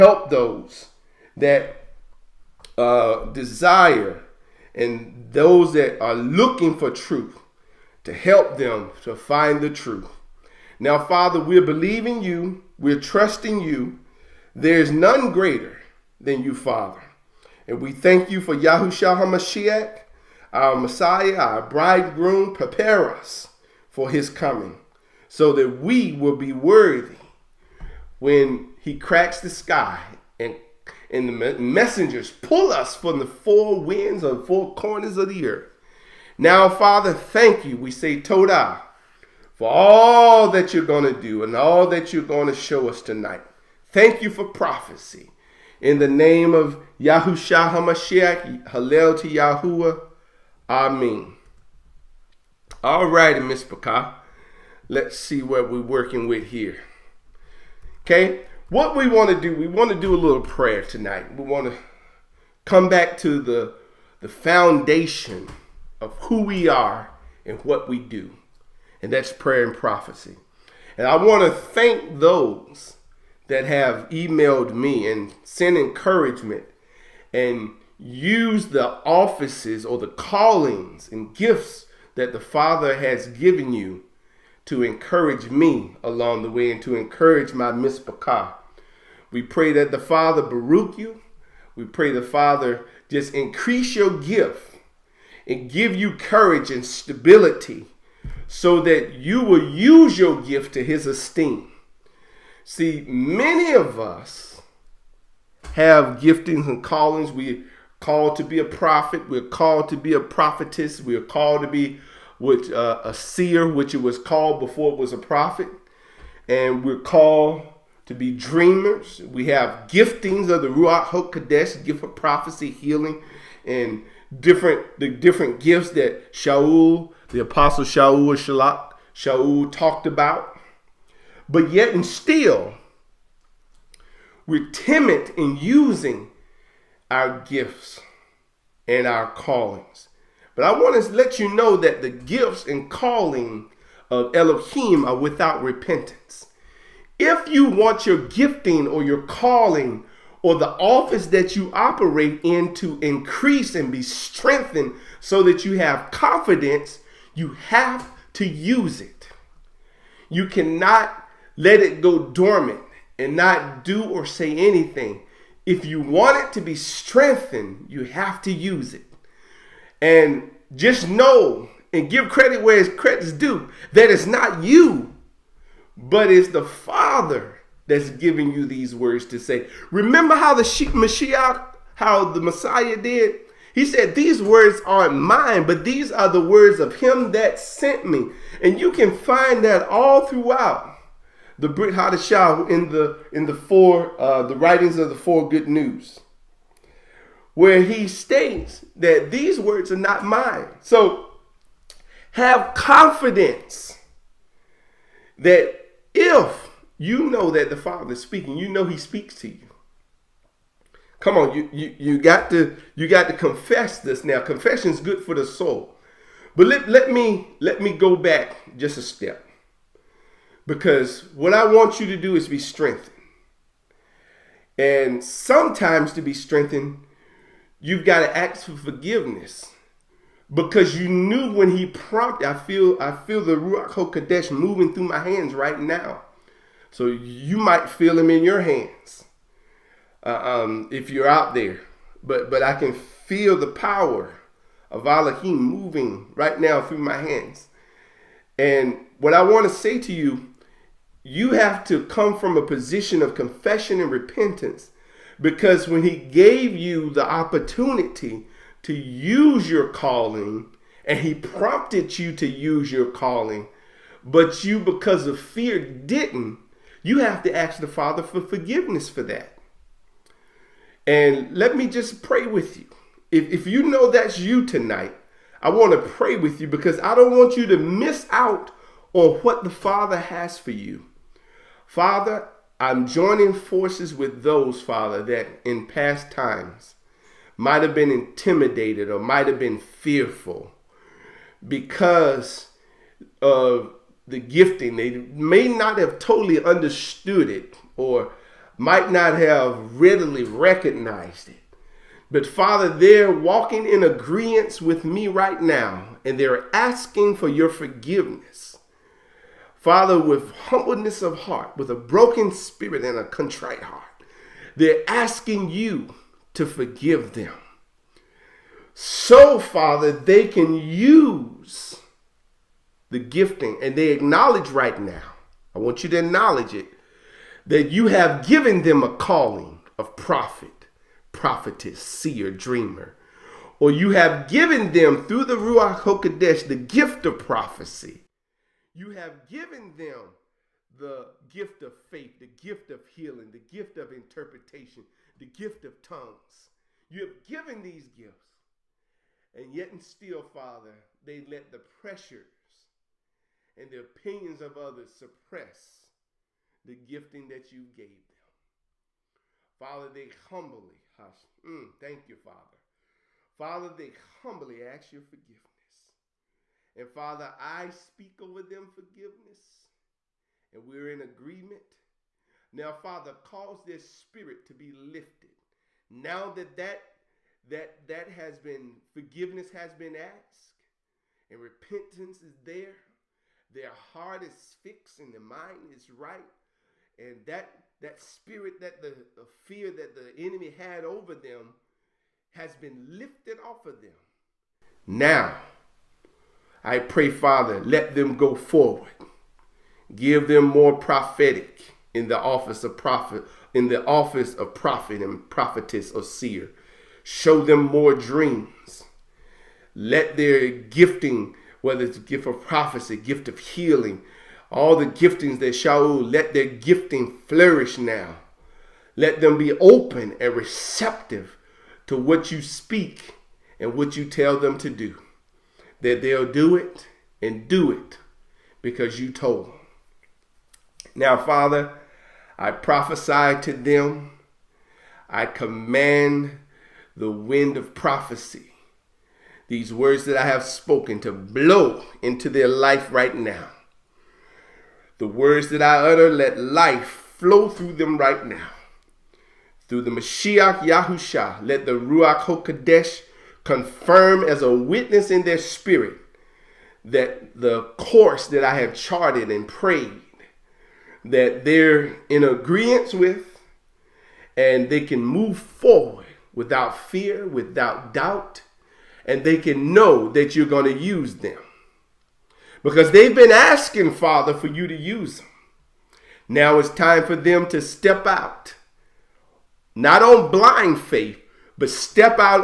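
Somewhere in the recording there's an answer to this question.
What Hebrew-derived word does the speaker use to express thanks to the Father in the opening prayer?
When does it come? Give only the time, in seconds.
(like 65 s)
38 s.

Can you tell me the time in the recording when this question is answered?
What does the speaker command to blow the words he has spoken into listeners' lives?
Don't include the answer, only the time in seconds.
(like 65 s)
437 s.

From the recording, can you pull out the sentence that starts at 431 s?
Now, Father, I prophesy to them.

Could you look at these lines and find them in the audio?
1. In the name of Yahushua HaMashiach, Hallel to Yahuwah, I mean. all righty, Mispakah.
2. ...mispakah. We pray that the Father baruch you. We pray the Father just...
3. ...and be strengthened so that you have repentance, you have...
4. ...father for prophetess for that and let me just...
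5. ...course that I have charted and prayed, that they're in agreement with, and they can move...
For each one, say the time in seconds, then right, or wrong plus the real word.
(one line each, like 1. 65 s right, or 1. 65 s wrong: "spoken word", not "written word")
1. 45 s right
2. 87 s right
3. 153 s wrong: "confidence", not "repentance"
4. 267 s wrong: "forgiveness", not "prophetess"
5. 457 s right.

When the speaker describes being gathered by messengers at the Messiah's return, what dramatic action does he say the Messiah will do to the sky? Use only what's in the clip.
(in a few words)
Cracks the sky.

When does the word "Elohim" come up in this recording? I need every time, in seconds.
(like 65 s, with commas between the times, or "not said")
144 s, 245 s.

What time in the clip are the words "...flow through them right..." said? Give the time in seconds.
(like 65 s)
447 s.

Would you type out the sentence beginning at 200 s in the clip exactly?
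So have confidence that if you know that the Father is speaking, you know He speaks to you.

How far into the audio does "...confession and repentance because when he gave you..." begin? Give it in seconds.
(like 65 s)
253 s.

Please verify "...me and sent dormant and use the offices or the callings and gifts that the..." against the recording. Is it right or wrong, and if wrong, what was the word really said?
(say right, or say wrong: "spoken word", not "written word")
wrong: "encouragement", not "dormant".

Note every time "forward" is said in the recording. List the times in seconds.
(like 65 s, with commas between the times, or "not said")
398 s, 465 s.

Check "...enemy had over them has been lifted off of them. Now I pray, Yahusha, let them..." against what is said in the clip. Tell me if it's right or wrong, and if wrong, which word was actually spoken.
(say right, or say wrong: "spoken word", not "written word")
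wrong: "Father", not "Yahusha".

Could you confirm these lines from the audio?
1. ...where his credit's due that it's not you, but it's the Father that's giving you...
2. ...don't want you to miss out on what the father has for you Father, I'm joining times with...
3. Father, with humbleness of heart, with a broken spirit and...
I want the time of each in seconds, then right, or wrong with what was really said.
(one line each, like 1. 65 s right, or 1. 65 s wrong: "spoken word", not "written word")
1. 172 s right
2. 277 s wrong: "forces", not "times"
3. 309 s right.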